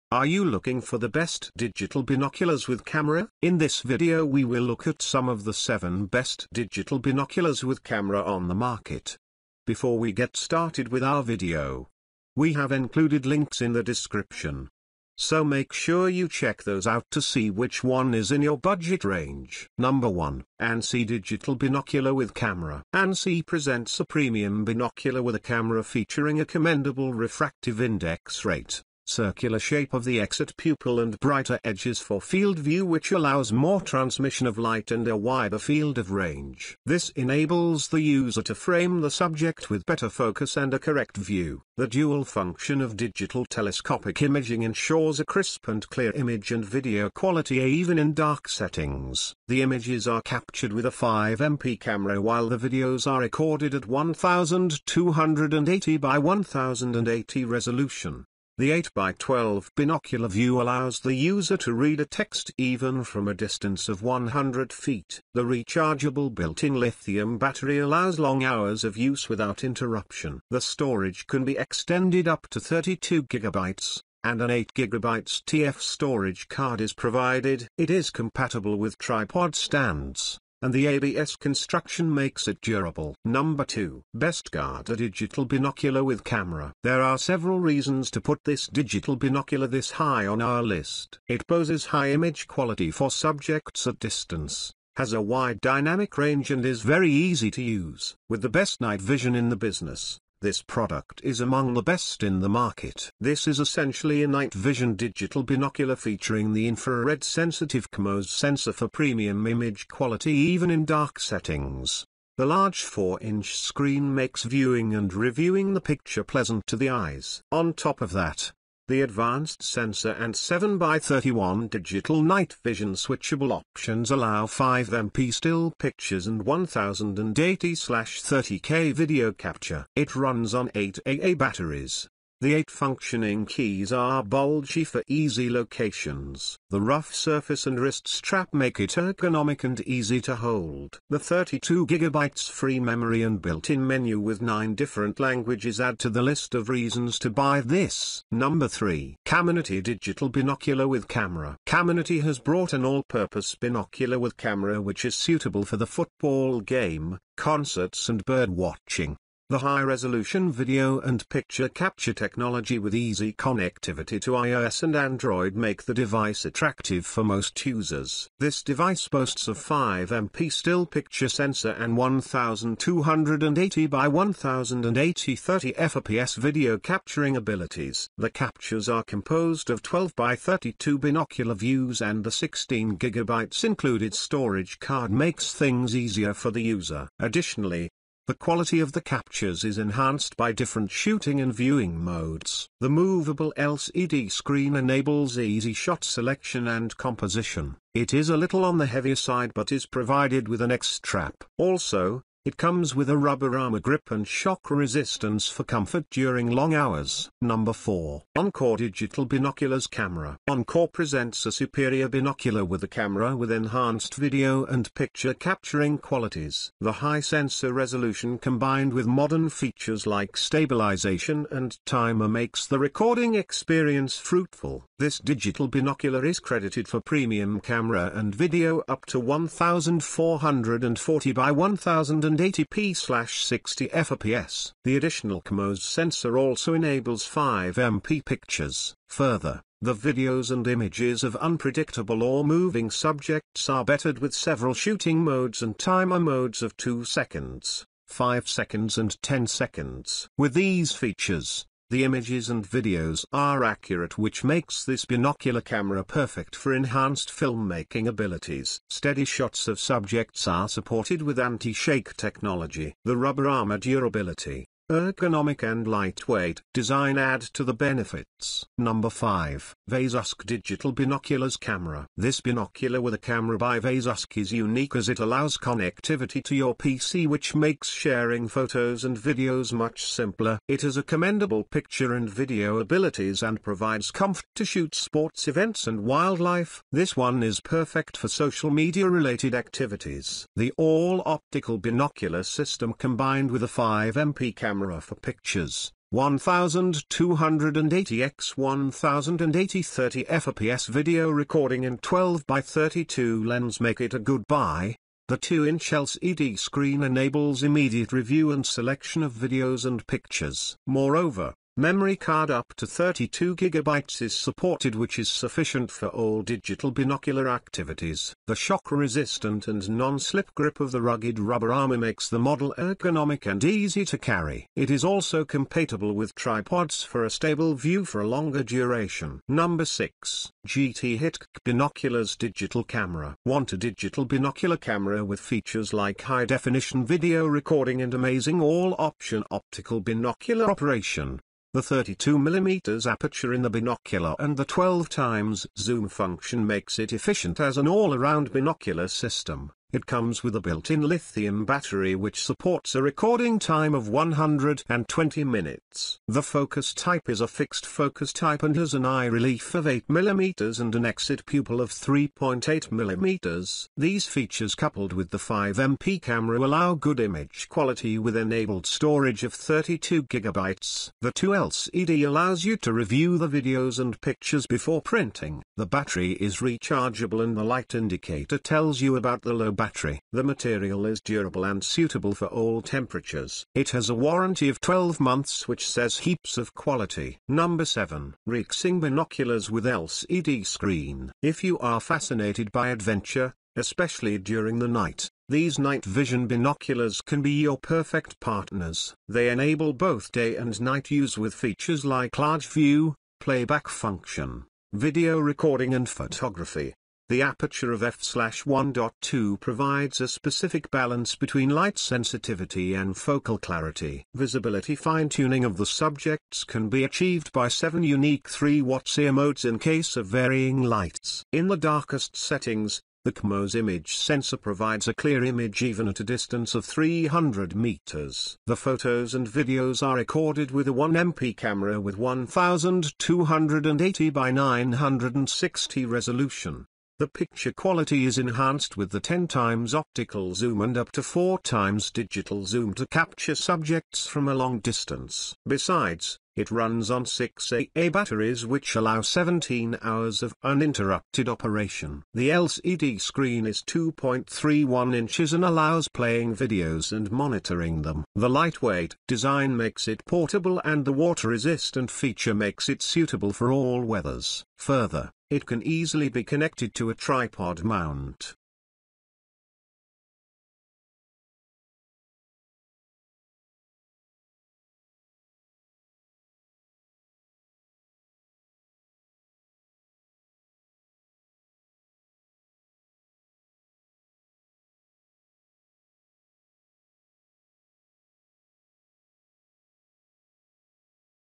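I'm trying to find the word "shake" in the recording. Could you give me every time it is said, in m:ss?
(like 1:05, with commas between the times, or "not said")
4:21.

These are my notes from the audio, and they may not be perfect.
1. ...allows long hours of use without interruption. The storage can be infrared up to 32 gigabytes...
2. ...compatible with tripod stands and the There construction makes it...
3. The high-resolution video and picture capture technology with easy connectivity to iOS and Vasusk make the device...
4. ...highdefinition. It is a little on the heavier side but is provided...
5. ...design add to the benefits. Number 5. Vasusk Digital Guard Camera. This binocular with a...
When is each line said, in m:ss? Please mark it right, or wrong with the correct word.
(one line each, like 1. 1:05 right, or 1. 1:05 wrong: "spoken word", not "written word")
1. 1:07 wrong: "extended", not "infrared"
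2. 1:18 wrong: "ABS", not "There"
3. 2:39 wrong: "Android", not "Vasusk"
4. 3:16 wrong: "composition", not "highdefinition"
5. 4:26 wrong: "Binoculars", not "Guard".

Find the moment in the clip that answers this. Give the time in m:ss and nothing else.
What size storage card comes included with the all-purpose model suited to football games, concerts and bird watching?
3:02.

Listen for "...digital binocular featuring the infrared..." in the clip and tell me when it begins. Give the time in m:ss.
1:44.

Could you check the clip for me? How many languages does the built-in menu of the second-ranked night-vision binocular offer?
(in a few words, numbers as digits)
9.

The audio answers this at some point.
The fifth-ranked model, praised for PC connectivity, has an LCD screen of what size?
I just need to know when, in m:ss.
5:05.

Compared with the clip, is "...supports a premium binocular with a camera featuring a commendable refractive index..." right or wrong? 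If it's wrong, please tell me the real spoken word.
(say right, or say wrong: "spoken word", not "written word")
wrong: "presents", not "supports".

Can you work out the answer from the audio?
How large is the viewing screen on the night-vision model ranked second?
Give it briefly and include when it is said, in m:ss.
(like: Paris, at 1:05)
4-inch, at 1:52.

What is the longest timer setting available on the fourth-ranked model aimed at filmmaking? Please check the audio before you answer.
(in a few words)
10 seconds.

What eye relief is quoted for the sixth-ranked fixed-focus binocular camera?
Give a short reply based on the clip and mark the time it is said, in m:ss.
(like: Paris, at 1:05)
8mm, at 5:59.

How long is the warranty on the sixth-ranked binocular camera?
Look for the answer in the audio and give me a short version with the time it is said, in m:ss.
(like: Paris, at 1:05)
12 months, at 6:24.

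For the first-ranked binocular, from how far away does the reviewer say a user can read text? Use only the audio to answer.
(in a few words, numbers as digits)
100 feet.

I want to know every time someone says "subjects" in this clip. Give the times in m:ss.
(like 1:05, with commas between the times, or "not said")
0:39, 1:33, 4:02, 4:19, 6:55, 7:23.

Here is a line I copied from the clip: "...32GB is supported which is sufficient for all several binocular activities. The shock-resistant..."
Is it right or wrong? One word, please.
wrong.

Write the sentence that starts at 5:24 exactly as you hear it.
It is also compatible with tripods for a stable view for a longer duration.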